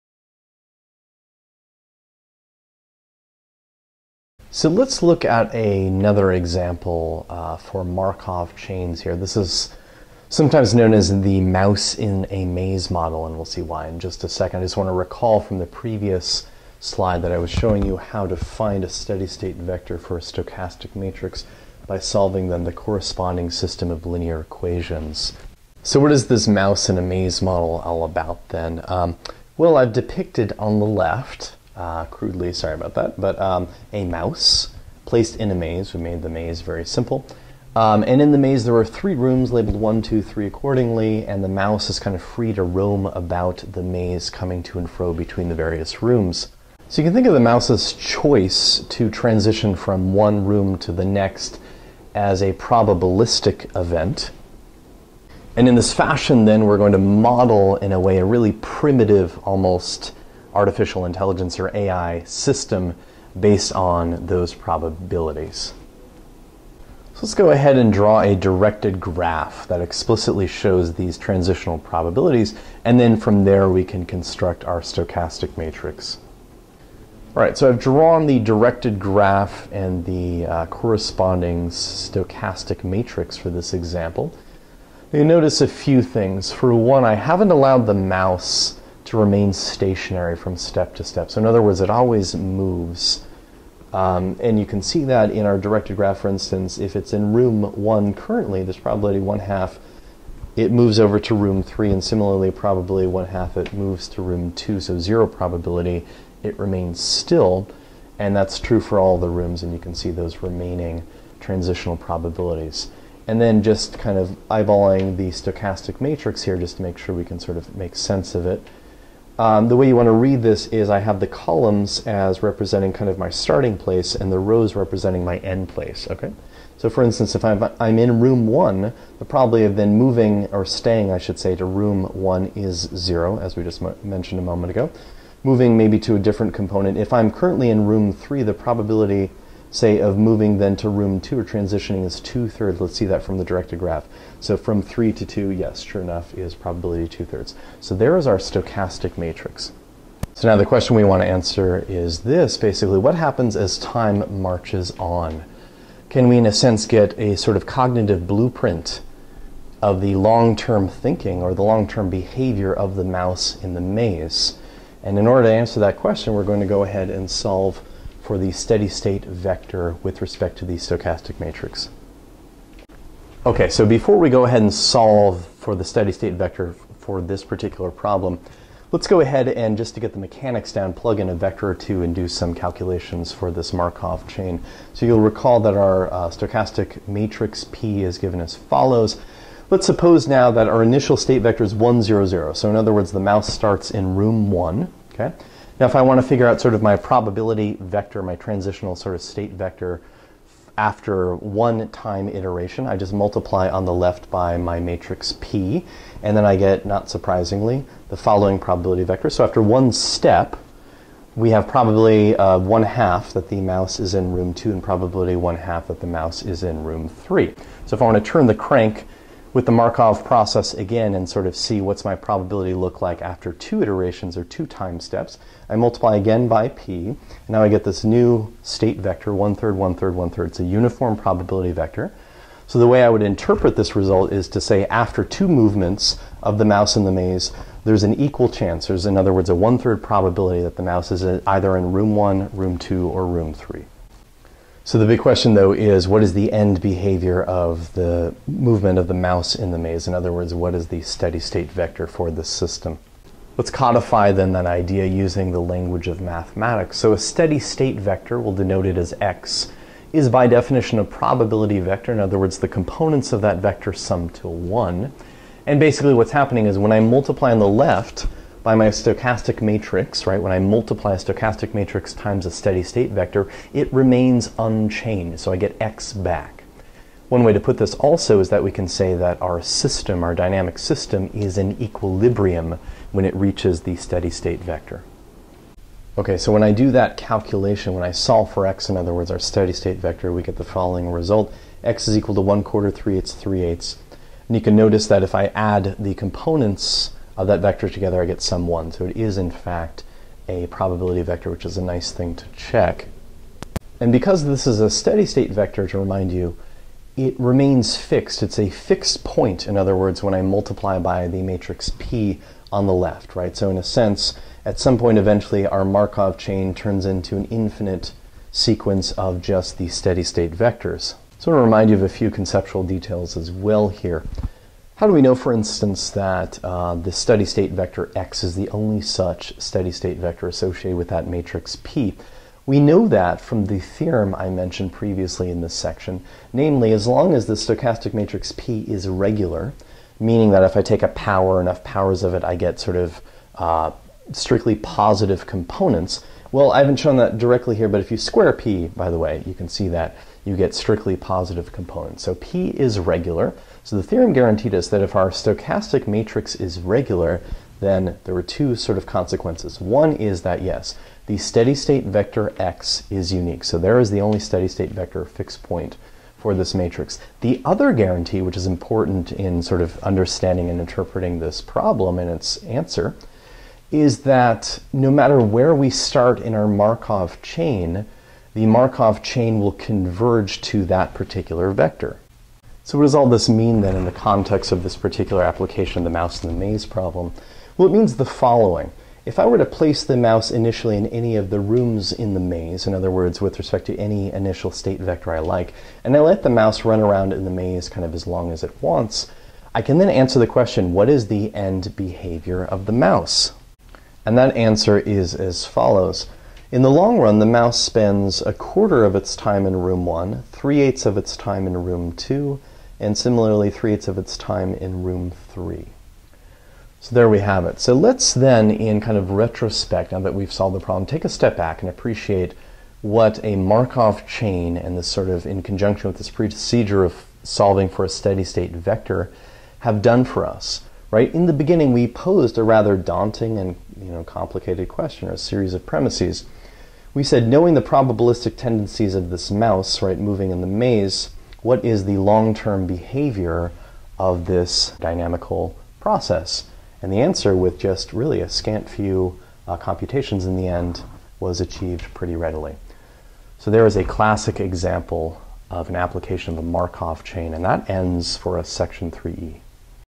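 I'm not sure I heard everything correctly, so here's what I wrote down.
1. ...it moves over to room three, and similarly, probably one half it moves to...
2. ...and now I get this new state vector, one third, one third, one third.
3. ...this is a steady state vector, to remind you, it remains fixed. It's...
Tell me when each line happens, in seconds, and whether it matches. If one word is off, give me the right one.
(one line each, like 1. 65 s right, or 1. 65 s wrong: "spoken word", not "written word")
1. 100 s right
2. 227 s right
3. 304 s right.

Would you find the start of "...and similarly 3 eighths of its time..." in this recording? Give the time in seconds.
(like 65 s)
412 s.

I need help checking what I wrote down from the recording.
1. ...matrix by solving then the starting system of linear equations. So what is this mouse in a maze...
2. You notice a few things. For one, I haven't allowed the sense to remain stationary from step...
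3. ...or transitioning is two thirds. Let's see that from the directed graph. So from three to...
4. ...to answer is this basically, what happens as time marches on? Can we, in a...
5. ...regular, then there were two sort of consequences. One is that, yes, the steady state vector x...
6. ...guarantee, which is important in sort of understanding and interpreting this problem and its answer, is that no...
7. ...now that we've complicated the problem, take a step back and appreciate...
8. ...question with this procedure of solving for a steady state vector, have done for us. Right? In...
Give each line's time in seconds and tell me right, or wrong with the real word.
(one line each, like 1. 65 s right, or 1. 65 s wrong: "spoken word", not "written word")
1. 20 s wrong: "corresponding", not "starting"
2. 85 s wrong: "mouse", not "sense"
3. 141 s right
4. 151 s right
5. 356 s right
6. 367 s right
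7. 420 s wrong: "solved", not "complicated"
8. 425 s wrong: "conjunction", not "question".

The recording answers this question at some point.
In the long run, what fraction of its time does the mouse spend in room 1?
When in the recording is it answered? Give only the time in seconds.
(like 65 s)
408 s.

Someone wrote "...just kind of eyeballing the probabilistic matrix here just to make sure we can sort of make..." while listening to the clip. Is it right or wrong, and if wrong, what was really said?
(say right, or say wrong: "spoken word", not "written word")
wrong: "stochastic", not "probabilistic".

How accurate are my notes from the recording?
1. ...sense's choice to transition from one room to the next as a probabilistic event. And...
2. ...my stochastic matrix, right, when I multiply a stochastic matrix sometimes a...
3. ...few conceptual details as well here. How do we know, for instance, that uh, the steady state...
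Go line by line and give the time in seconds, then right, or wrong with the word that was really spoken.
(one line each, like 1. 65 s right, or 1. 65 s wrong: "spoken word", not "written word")
1. 47 s wrong: "mouse", not "sense"
2. 268 s wrong: "times", not "sometimes"
3. 322 s right.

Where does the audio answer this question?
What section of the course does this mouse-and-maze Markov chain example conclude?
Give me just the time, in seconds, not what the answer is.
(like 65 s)
459 s.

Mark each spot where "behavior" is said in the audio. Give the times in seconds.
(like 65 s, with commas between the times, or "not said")
162 s, 246 s, 401 s, 442 s.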